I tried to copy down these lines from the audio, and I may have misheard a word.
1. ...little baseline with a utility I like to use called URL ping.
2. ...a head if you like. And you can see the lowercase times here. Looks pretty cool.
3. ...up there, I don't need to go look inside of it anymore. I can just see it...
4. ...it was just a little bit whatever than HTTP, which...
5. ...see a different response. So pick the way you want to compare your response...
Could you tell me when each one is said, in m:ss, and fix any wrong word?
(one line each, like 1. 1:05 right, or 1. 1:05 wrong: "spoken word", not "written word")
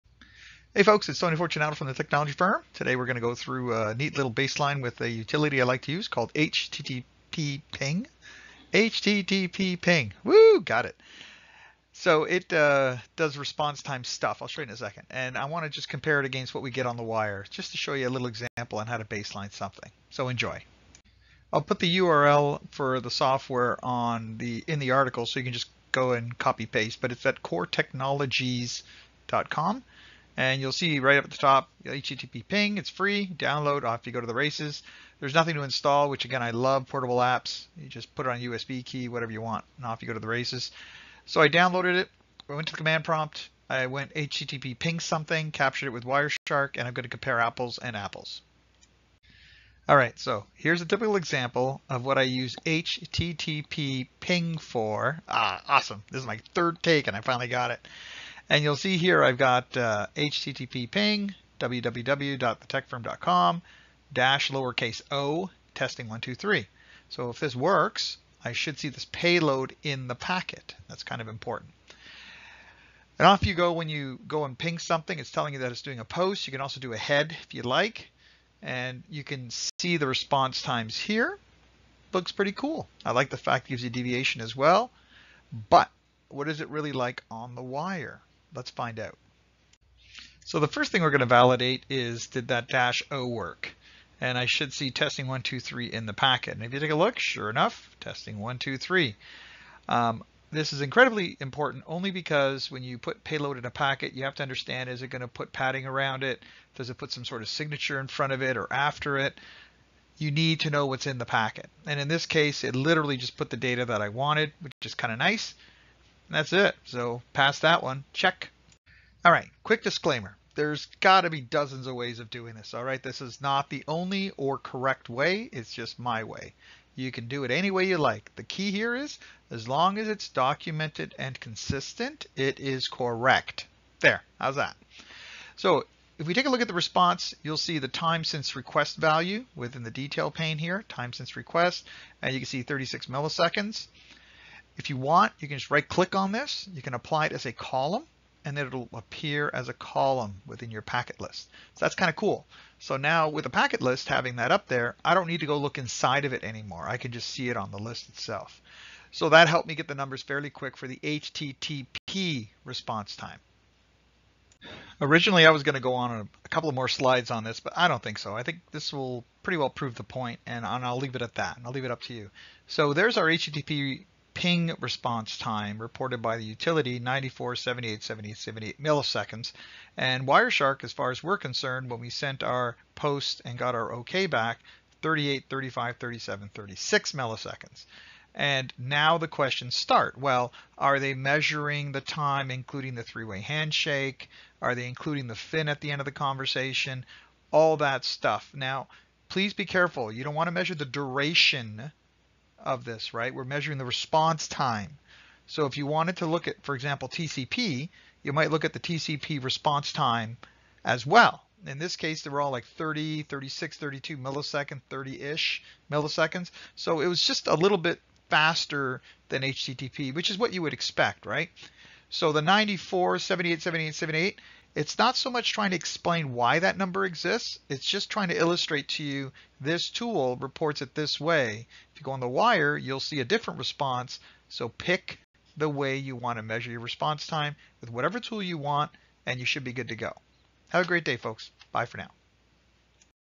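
1. 0:04 wrong: "HTTP", not "URL"
2. 1:16 wrong: "response", not "lowercase"
3. 2:34 right
4. 3:37 wrong: "faster", not "whatever"
5. 3:53 wrong: "measure", not "compare".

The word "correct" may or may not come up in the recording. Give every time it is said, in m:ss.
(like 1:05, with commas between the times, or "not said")
2:04, 2:12.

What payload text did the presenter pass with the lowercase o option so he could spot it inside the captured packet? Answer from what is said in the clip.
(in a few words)
testing 123.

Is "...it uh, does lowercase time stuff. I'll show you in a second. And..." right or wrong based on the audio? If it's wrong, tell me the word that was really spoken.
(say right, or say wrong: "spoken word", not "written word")
wrong: "response", not "lowercase".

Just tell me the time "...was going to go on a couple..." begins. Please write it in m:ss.
2:45.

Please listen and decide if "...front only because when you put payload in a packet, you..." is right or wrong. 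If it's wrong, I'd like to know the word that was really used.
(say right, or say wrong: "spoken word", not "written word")
wrong: "important", not "front".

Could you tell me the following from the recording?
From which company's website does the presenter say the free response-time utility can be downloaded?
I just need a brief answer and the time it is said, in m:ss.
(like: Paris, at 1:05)
coretechnologies.com, at 0:27.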